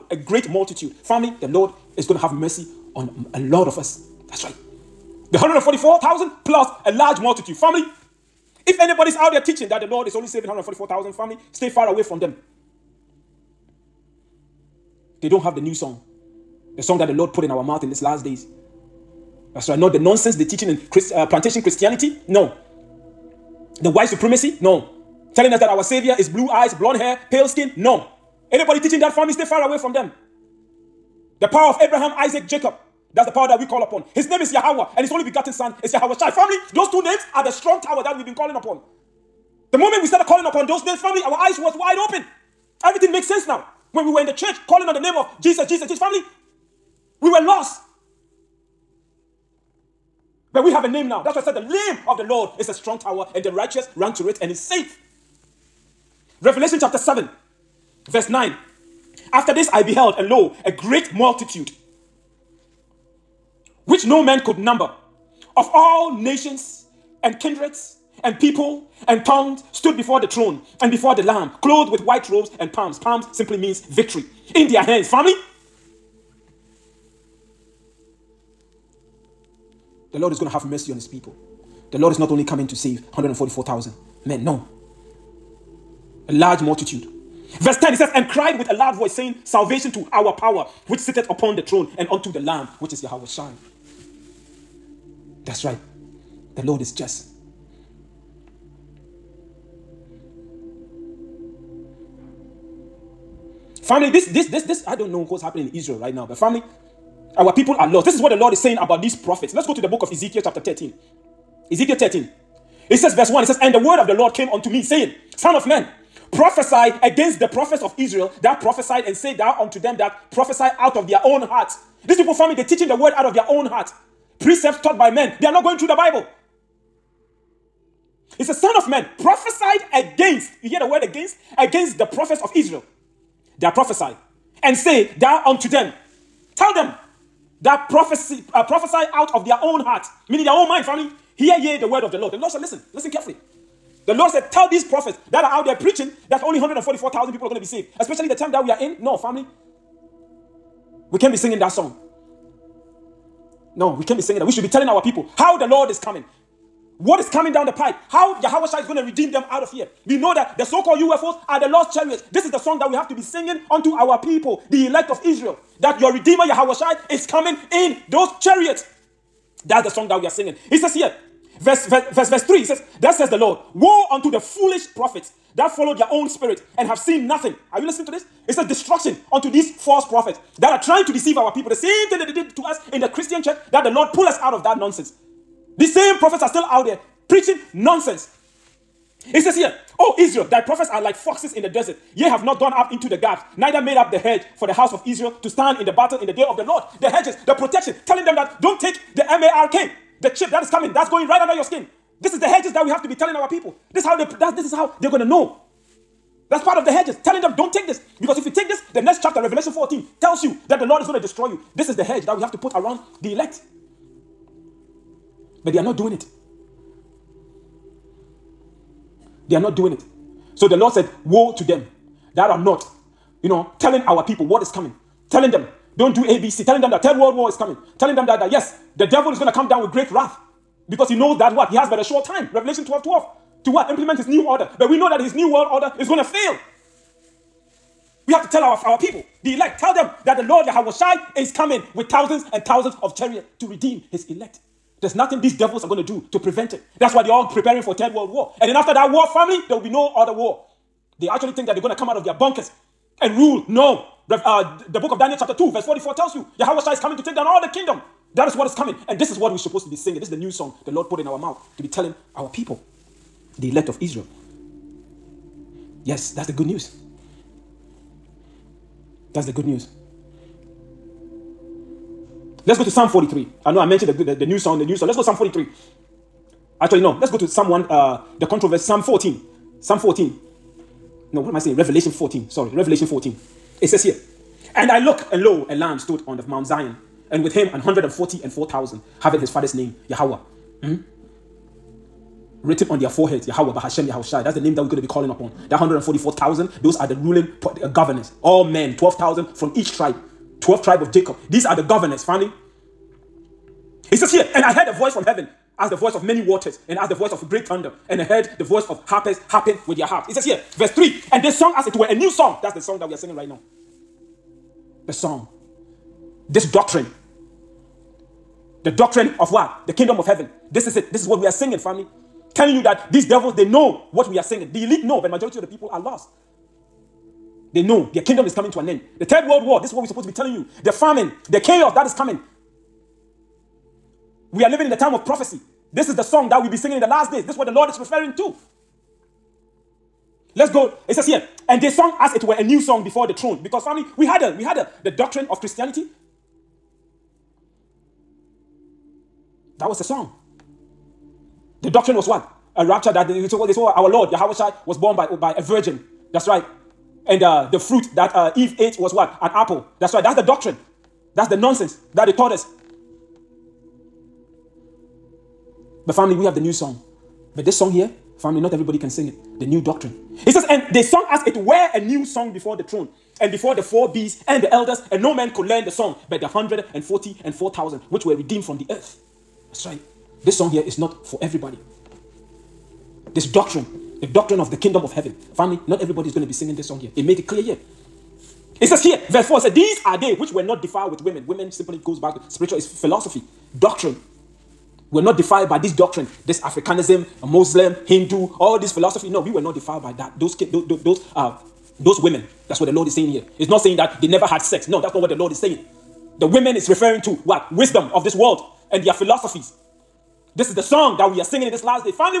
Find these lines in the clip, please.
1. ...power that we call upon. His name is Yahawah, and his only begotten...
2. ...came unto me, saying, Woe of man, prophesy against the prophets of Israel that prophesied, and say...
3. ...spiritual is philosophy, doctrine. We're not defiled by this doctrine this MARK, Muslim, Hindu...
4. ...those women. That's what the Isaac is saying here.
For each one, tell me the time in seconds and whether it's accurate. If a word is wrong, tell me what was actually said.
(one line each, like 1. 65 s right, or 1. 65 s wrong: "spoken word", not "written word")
1. 33 s right
2. 114 s wrong: "Son", not "Woe"
3. 392 s wrong: "Africanism", not "MARK"
4. 401 s wrong: "Lord", not "Isaac".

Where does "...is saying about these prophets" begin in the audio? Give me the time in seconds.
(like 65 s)
108 s.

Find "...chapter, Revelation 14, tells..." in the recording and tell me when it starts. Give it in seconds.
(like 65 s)
209 s.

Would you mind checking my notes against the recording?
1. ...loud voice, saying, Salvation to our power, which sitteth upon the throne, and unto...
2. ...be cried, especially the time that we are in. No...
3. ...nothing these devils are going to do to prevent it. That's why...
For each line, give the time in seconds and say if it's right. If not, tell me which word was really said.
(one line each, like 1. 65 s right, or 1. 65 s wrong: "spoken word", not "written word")
1. 88 s right
2. 147 s wrong: "saved", not "cried"
3. 245 s right.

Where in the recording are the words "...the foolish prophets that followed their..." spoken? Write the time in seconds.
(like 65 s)
174 s.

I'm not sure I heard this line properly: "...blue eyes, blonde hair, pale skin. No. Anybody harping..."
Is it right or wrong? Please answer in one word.
wrong.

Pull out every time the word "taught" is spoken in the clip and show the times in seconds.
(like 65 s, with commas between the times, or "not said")
124 s, 362 s.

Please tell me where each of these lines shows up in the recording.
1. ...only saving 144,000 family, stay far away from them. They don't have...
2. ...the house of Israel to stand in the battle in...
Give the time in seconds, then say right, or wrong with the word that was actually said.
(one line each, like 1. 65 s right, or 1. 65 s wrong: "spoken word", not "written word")
1. 10 s right
2. 194 s right.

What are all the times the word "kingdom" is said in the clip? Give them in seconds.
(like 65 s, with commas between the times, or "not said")
257 s, 319 s, 328 s, 384 s.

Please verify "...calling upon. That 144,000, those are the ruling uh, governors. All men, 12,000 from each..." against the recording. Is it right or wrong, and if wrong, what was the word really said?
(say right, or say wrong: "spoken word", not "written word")
right.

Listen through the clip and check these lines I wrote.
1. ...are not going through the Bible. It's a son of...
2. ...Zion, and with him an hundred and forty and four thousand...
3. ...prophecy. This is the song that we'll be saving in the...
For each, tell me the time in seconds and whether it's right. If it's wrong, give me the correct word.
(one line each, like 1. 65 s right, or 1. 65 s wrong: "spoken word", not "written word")
1. 125 s right
2. 286 s right
3. 335 s wrong: "singing", not "saving".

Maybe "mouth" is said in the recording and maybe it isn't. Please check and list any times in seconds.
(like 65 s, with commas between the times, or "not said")
17 s, 261 s.